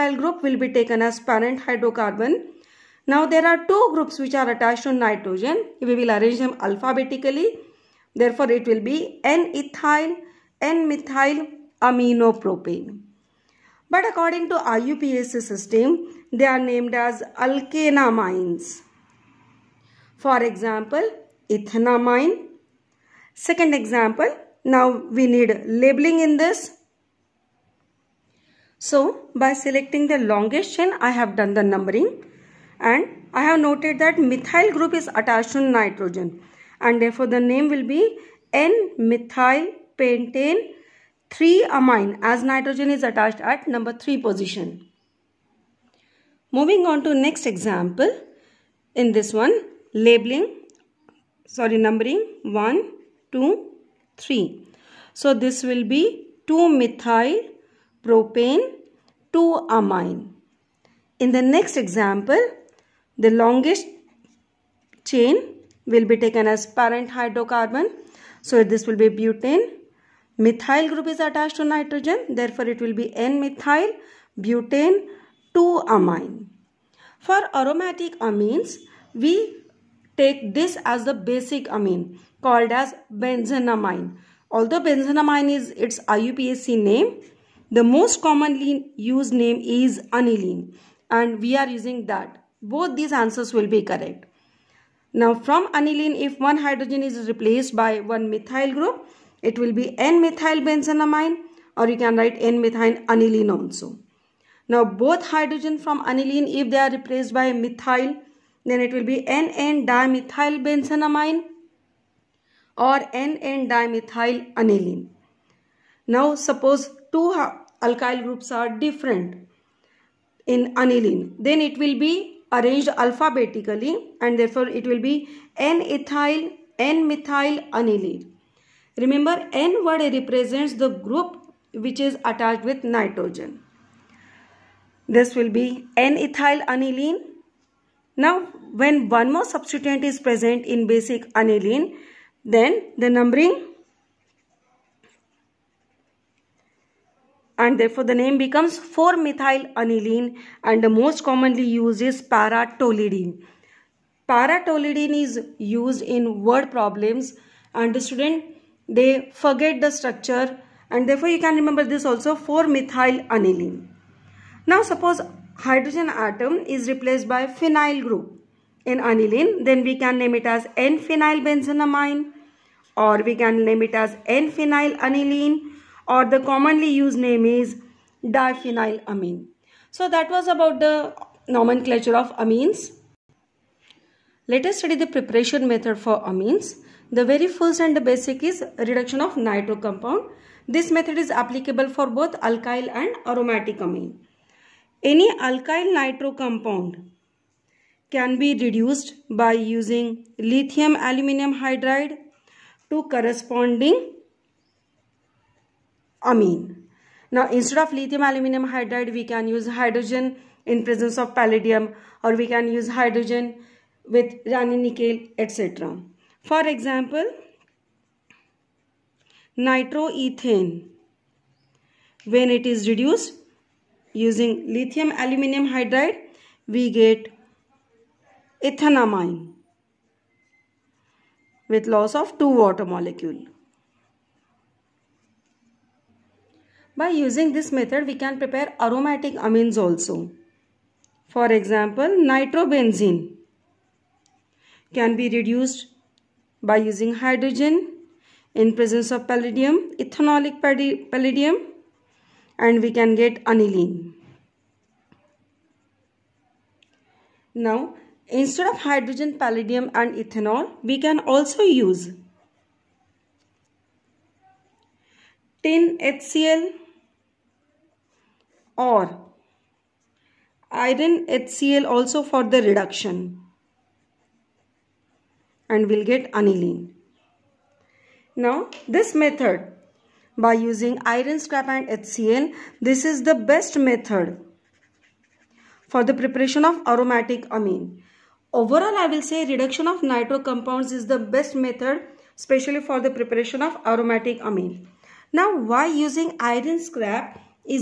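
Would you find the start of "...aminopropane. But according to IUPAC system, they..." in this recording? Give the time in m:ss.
0:11.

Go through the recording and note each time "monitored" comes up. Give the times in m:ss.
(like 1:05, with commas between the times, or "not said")
not said.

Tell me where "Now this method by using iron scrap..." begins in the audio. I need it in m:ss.
4:38.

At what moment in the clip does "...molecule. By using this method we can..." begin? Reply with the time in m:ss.
3:52.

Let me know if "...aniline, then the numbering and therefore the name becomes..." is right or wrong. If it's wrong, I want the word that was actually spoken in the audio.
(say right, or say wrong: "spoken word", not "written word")
right.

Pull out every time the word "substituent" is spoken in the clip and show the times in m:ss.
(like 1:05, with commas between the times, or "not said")
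2:19.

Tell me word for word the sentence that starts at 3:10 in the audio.
This method is applicable for both alkyl and aromatic amine.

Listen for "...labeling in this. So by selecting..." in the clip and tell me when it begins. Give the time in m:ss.
0:25.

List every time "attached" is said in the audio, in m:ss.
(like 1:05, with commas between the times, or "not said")
0:04, 0:35, 0:43, 1:11, 2:12.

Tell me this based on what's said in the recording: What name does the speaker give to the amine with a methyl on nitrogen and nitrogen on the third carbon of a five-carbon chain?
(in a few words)
N-methyl pentane 3-amine.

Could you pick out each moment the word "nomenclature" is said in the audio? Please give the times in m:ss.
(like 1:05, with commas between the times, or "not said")
3:01.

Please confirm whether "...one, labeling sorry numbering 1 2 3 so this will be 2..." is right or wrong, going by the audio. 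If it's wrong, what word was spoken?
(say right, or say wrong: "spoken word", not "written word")
right.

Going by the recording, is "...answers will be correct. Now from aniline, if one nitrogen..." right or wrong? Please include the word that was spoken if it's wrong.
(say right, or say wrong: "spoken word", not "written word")
wrong: "hydrogen", not "nitrogen".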